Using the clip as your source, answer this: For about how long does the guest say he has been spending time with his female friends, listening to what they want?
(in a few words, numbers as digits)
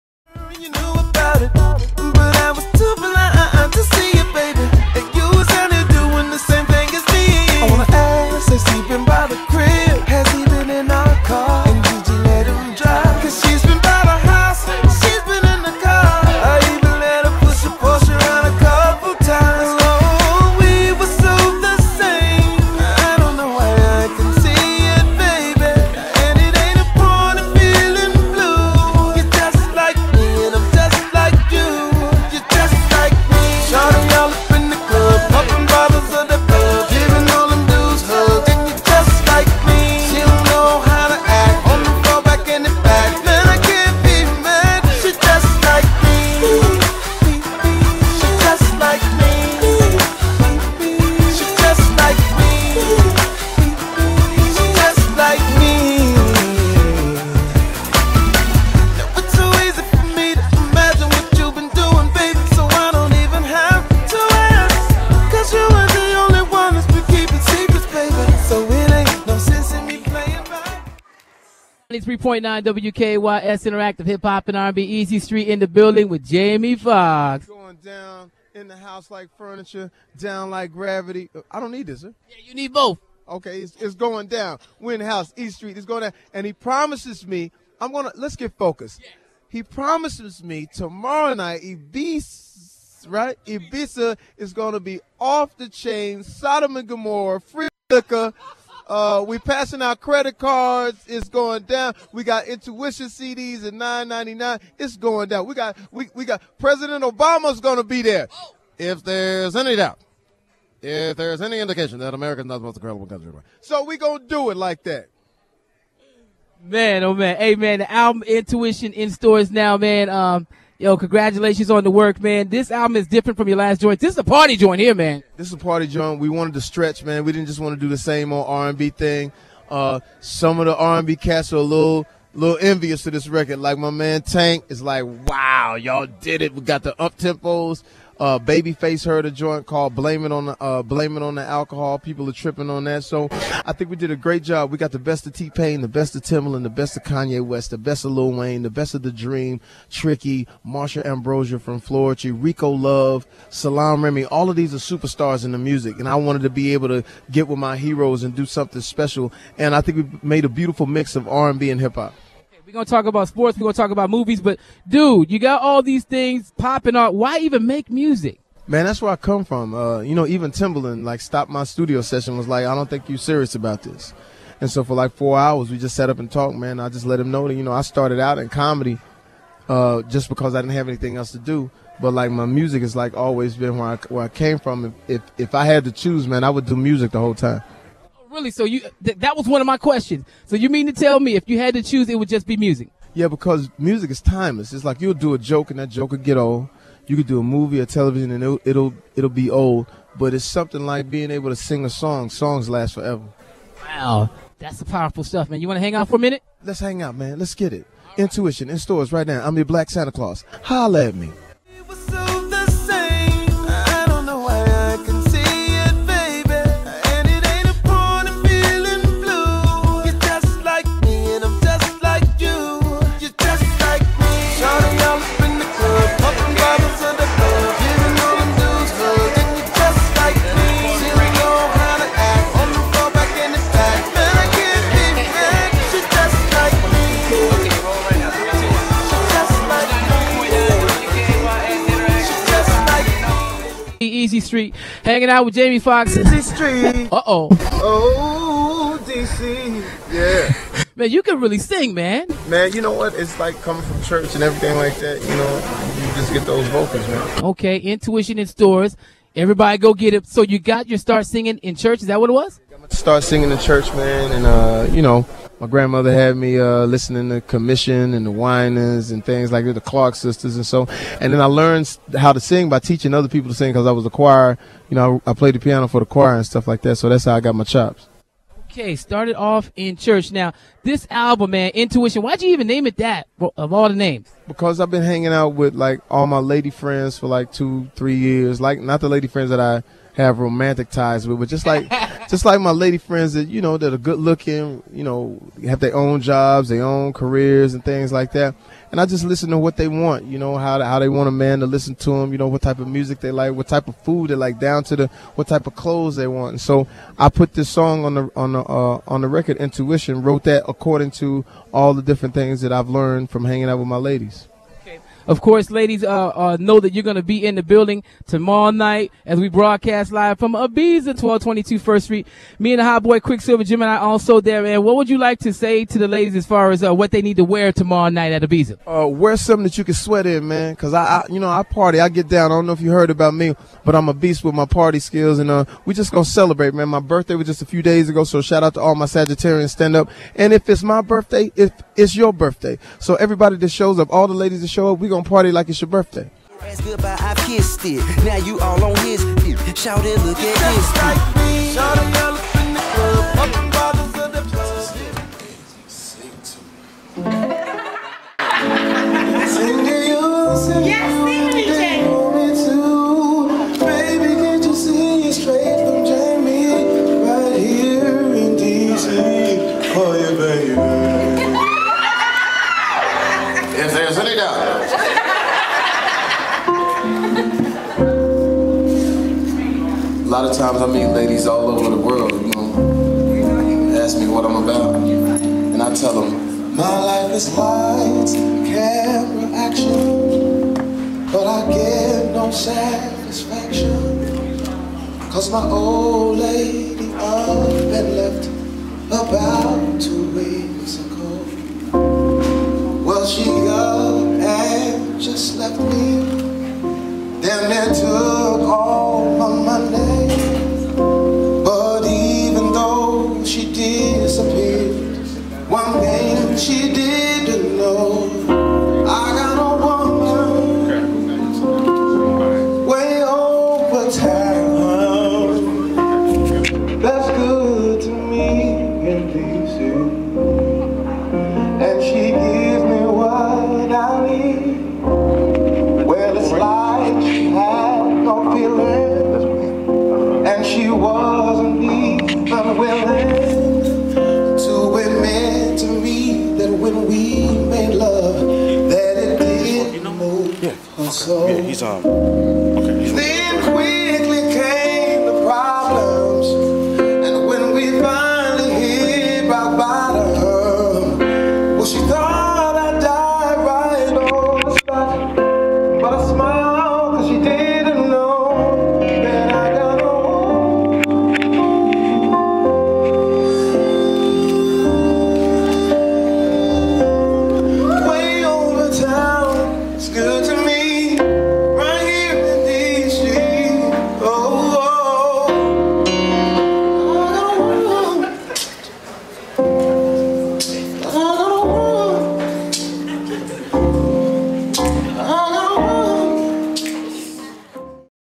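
2-3 years.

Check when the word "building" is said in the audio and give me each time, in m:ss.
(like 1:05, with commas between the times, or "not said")
1:15, 5:17.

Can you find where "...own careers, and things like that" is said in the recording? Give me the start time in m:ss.
4:56.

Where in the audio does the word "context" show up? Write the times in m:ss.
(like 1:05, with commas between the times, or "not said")
not said.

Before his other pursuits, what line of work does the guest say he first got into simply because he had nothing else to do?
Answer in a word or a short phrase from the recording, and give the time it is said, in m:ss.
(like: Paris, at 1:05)
Comedy, at 2:58.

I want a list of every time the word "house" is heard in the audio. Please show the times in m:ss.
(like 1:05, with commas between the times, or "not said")
1:18, 1:25.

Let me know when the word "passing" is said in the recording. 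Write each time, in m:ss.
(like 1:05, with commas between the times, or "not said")
1:39.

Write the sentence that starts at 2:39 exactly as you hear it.
And I think we made a beautiful mix of R and B and hip hop.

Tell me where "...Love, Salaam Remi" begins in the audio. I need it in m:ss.
2:32.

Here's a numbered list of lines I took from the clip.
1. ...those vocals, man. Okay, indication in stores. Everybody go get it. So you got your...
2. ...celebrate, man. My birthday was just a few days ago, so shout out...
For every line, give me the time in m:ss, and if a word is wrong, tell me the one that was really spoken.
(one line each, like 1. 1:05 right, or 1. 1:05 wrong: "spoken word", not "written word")
1. 4:16 wrong: "intuition", not "indication"
2. 5:36 right.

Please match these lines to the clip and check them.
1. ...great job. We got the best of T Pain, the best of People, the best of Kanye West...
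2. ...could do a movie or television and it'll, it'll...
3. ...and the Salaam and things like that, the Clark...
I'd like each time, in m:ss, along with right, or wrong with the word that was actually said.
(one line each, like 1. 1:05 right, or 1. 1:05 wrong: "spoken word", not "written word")
1. 2:24 wrong: "Timbaland", not "People"
2. 3:17 right
3. 4:28 wrong: "Winans", not "Salaam".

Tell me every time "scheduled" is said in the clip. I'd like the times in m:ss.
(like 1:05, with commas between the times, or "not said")
not said.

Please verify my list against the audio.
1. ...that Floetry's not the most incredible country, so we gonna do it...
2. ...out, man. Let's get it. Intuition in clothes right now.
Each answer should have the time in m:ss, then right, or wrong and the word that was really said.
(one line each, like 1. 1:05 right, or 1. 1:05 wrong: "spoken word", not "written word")
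1. 1:51 wrong: "America", not "Floetry"
2. 3:27 wrong: "stores", not "clothes".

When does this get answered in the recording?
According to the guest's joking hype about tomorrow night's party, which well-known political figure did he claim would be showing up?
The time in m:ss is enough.
1:46.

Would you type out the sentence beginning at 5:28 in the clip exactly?
Uh, wear something that you can sweat in, man.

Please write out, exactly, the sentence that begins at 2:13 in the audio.
Like my man Tank is like, wow, y'all did it.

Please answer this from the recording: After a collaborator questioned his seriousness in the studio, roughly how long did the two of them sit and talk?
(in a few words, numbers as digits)
4 hours.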